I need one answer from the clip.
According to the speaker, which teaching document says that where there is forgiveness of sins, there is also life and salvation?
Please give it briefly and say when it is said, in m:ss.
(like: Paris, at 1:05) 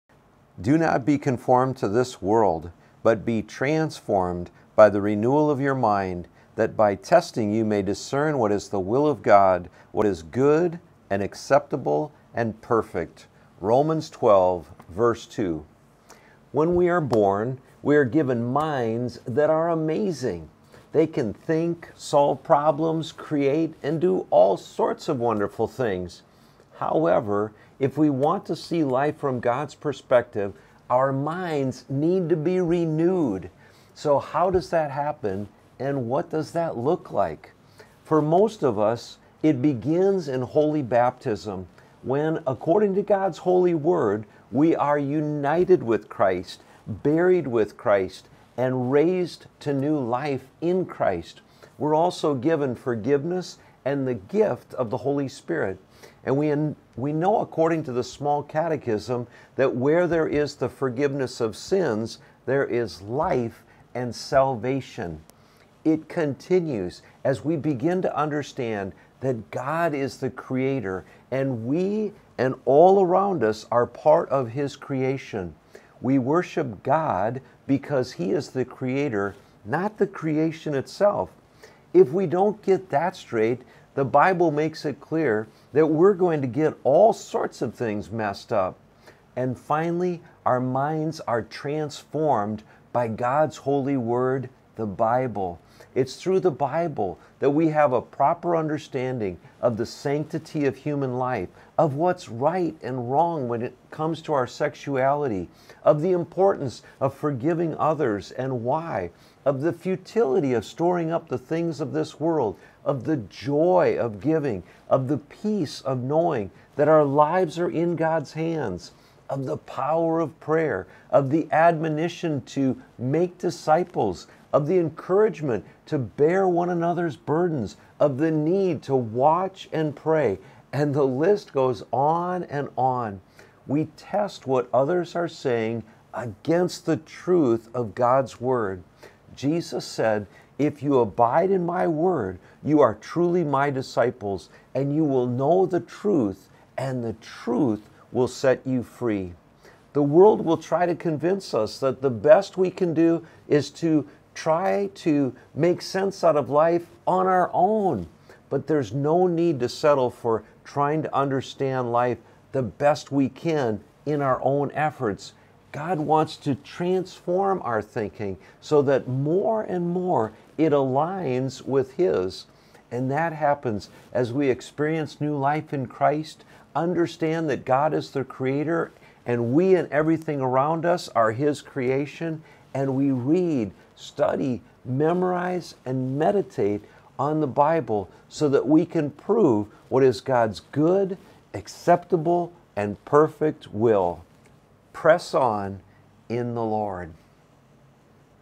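the small catechism, at 0:57.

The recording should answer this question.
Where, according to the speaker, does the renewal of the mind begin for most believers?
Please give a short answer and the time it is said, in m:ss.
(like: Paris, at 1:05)
holy baptism, at 0:40.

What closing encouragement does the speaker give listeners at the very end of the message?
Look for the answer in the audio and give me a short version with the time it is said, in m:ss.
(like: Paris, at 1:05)
Press on in the Lord, at 3:14.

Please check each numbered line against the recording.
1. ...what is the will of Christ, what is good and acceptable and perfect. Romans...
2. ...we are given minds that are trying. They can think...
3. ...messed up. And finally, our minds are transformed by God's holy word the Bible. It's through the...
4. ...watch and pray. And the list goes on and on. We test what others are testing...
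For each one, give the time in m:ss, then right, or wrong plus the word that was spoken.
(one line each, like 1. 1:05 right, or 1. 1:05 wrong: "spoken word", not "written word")
1. 0:08 wrong: "God", not "Christ"
2. 0:17 wrong: "amazing", not "trying"
3. 1:28 right
4. 2:08 wrong: "saying", not "testing".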